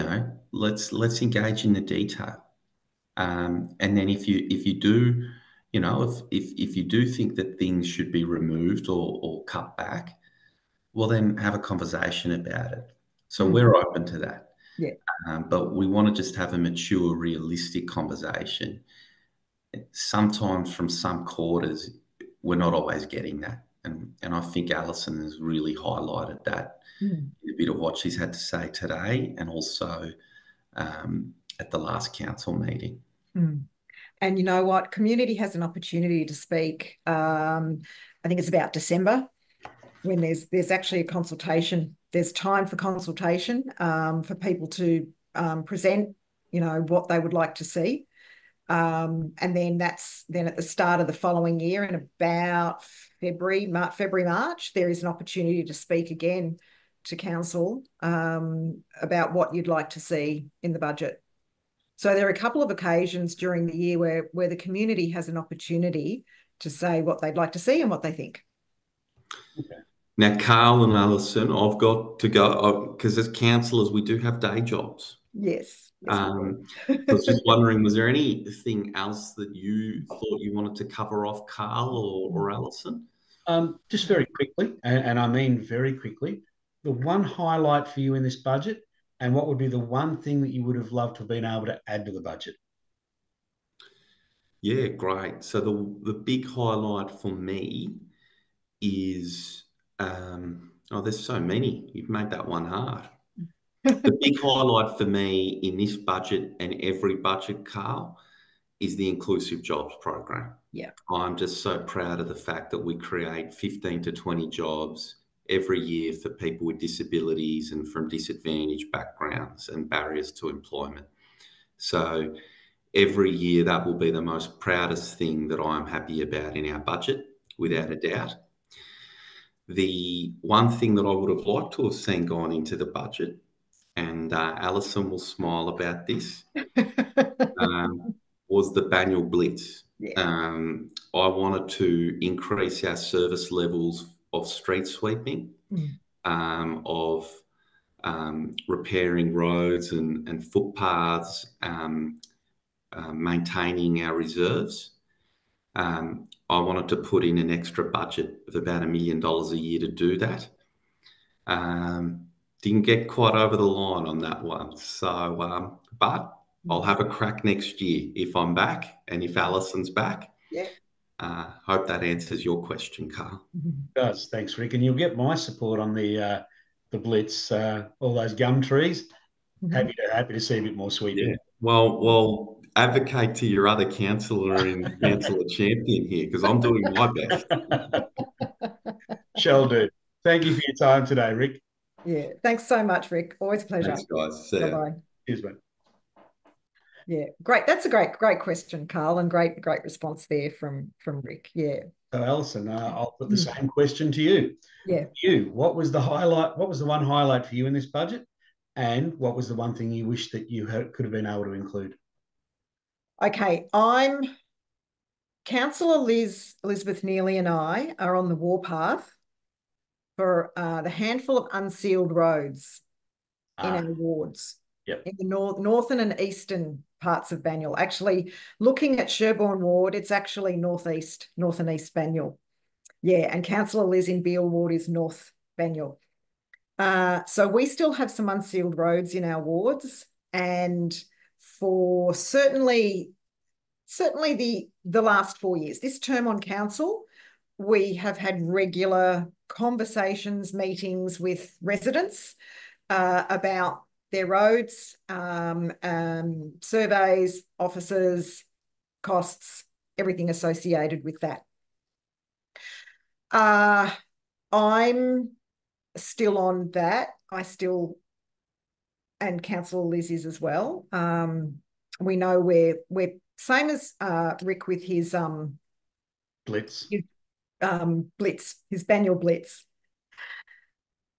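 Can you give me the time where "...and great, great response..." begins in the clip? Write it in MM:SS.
03:19.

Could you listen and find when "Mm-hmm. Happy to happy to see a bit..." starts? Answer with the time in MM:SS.
02:59.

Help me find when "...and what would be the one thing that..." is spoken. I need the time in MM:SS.
01:29.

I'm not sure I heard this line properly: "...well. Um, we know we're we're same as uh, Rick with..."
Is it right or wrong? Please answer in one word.
right.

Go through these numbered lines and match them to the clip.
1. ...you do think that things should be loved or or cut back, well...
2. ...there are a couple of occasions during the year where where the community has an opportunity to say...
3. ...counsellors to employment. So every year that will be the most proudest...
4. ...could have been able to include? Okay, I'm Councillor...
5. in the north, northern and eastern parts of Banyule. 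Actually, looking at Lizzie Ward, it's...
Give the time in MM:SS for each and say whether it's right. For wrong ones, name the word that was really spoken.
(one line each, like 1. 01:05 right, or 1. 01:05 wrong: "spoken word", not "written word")
1. 00:06 wrong: "removed", not "loved"
2. 01:02 right
3. 01:59 wrong: "barriers", not "counsellors"
4. 03:30 right
5. 03:45 wrong: "Sherbourne", not "Lizzie".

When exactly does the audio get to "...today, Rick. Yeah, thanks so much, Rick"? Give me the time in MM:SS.
03:11.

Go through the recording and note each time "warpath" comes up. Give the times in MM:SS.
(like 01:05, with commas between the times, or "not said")
03:38.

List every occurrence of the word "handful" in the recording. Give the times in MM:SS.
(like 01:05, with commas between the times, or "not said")
03:40.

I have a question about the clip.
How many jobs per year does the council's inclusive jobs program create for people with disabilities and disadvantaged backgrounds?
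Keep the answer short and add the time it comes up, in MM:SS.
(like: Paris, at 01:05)
15 to 20, at 01:53.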